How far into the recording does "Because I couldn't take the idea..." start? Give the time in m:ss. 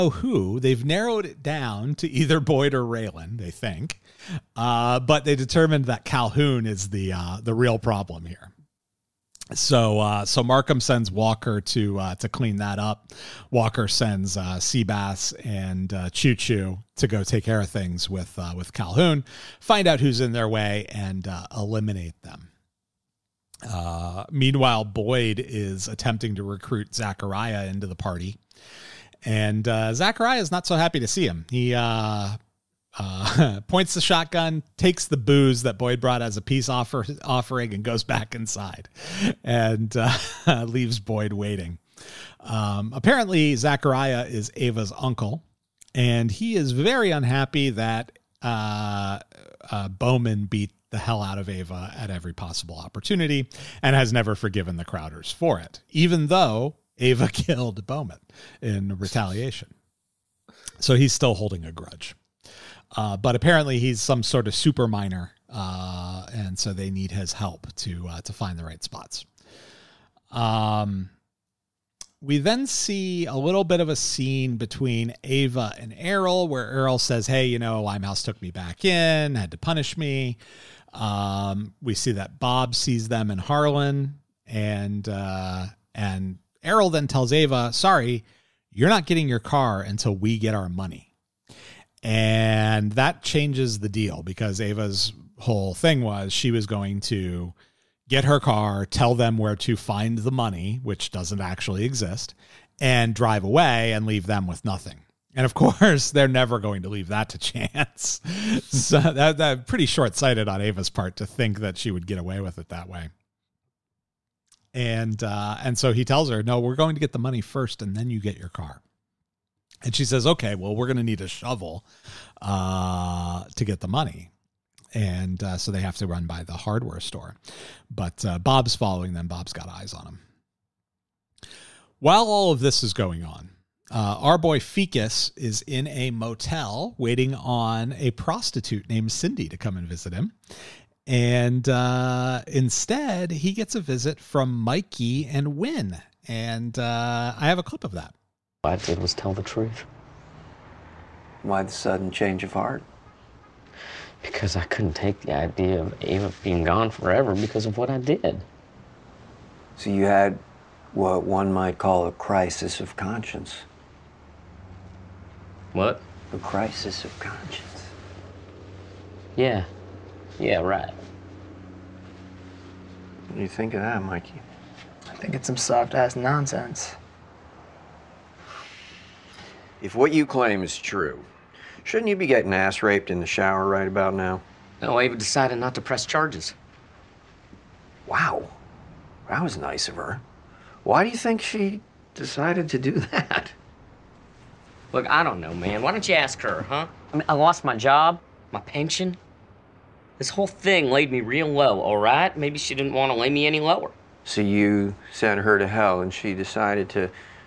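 2:34.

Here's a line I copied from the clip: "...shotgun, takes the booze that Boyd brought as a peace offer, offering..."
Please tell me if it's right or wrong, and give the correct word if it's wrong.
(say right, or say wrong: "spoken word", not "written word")
right.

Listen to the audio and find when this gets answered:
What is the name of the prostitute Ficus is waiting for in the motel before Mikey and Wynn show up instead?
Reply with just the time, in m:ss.
2:19.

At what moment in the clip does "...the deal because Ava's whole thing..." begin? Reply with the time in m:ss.
1:33.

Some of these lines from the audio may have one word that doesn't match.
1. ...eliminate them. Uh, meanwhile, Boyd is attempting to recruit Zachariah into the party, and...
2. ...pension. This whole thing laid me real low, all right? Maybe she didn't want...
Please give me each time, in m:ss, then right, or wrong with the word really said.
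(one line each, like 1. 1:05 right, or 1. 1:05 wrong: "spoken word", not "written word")
1. 0:21 right
2. 3:18 right.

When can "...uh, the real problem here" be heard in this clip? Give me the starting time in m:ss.
0:07.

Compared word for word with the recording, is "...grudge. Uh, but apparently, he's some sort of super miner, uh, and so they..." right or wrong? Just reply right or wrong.
right.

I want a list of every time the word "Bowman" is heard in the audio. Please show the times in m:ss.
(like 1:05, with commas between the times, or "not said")
0:49, 0:57.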